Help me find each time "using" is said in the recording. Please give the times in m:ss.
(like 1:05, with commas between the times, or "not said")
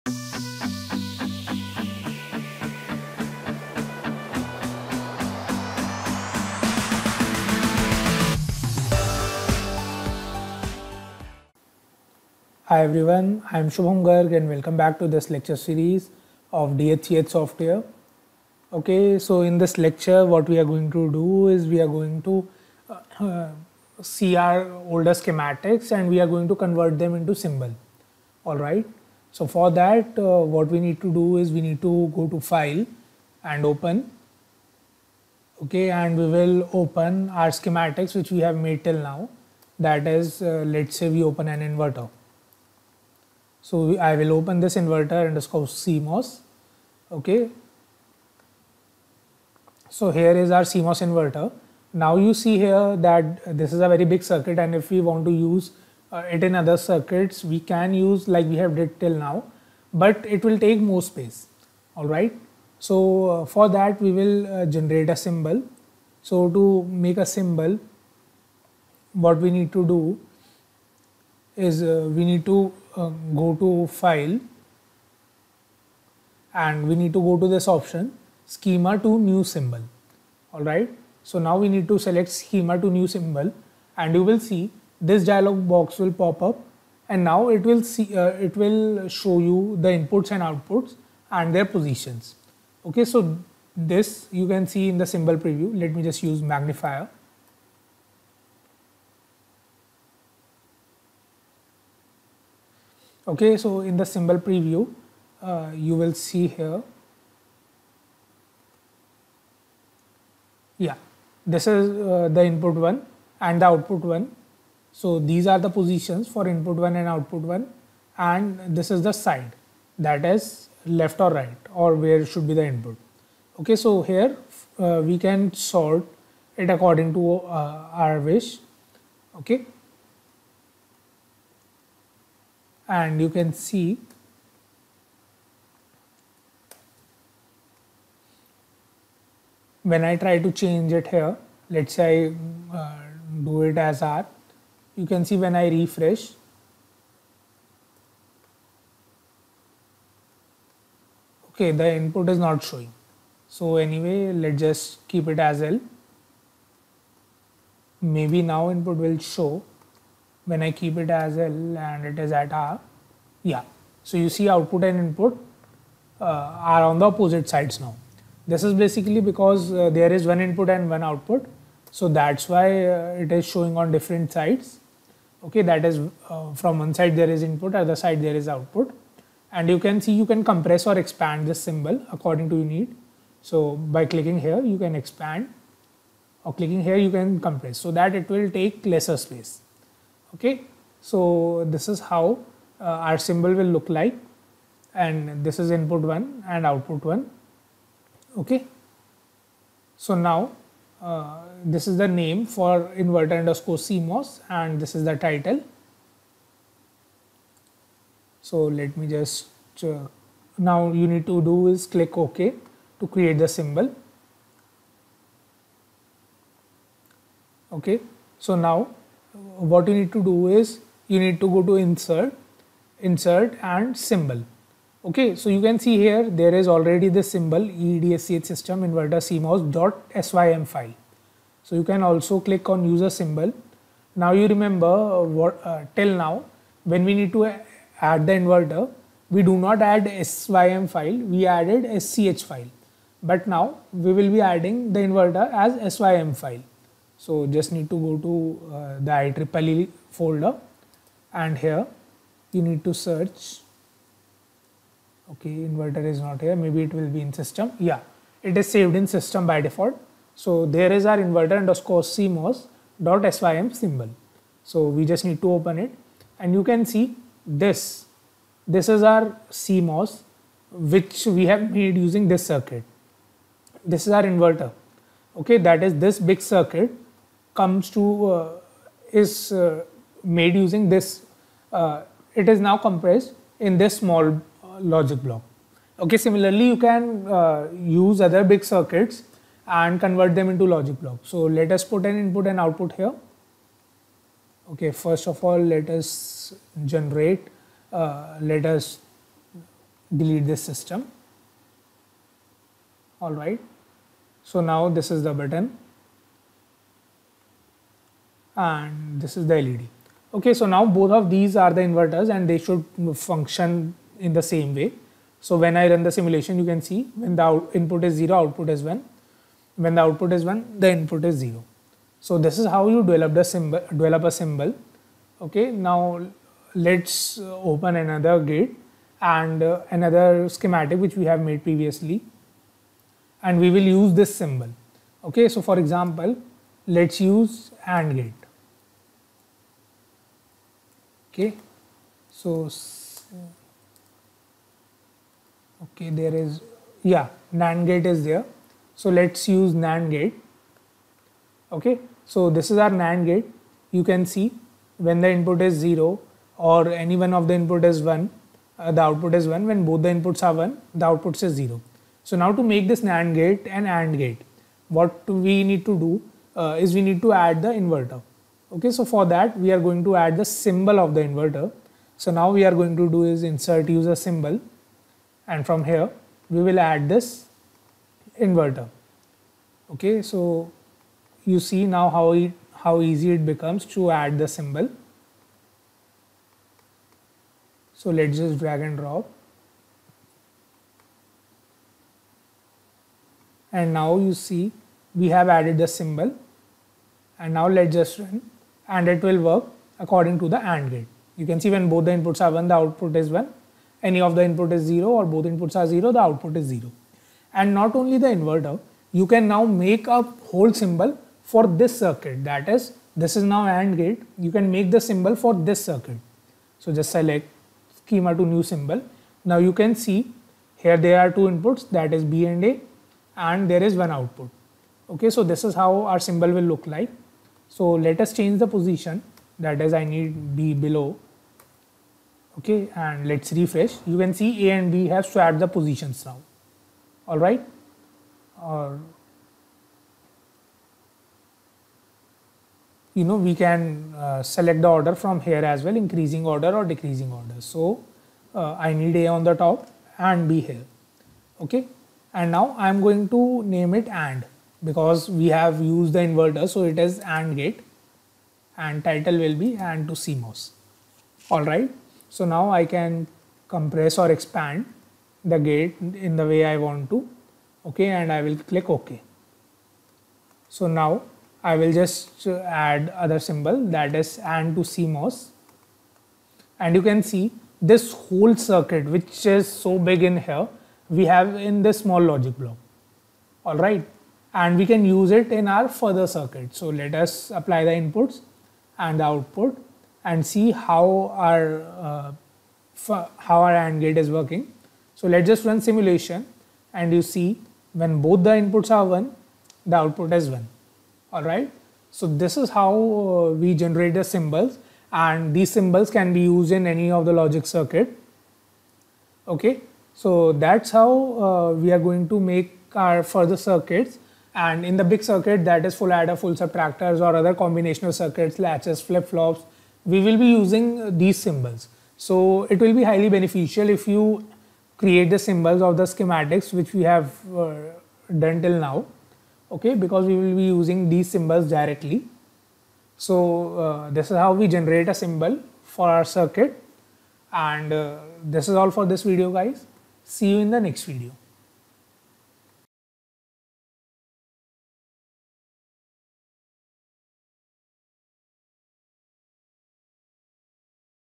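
4:32, 4:40, 8:40, 8:50.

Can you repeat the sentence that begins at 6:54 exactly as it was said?
You can make the symbol for this circuit.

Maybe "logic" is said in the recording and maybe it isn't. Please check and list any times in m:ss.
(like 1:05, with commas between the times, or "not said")
4:44, 4:50, 8:02, 8:27.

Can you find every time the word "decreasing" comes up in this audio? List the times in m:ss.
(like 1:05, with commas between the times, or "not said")
7:26.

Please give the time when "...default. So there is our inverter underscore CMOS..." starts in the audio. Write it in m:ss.
4:19.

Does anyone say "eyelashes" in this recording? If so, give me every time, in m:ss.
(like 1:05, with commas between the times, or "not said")
not said.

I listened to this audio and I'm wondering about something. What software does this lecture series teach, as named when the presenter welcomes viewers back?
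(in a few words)
DSCH.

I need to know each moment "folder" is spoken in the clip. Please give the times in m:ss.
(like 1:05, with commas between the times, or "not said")
4:10.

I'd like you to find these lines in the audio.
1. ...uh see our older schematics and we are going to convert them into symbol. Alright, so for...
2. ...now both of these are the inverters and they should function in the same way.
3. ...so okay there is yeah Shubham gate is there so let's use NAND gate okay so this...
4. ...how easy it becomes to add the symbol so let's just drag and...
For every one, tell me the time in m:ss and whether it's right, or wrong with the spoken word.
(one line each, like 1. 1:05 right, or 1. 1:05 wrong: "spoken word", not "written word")
1. 0:23 right
2. 5:10 right
3. 5:42 wrong: "NAND", not "Shubham"
4. 6:22 right.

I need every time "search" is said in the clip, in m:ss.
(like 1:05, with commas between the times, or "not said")
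4:12.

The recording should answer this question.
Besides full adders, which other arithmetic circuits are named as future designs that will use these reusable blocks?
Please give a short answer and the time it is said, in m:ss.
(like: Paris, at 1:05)
full subtractors, at 8:36.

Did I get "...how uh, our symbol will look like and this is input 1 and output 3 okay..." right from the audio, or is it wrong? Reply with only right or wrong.
wrong.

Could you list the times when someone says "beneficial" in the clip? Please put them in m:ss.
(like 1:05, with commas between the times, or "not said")
8:43.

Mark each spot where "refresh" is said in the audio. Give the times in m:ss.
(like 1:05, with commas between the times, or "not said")
2:25, 7:13.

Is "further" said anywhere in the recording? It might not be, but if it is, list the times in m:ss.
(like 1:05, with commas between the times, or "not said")
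8:05, 8:33.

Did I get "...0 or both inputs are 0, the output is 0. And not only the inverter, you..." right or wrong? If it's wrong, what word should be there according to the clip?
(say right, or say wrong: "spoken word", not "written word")
right.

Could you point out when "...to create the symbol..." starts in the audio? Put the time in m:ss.
3:32.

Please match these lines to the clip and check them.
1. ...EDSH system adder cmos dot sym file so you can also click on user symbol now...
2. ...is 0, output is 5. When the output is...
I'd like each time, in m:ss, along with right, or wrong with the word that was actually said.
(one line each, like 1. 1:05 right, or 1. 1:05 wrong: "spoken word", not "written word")
1. 3:47 wrong: "inverter", not "adder"
2. 5:18 wrong: "1", not "5".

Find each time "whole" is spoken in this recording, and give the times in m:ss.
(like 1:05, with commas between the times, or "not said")
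6:50, 7:58.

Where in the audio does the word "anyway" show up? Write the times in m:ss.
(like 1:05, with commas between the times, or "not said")
2:33.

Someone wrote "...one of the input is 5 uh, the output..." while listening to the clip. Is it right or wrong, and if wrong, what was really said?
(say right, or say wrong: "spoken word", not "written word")
wrong: "1", not "5".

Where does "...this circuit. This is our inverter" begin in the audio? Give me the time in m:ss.
4:32.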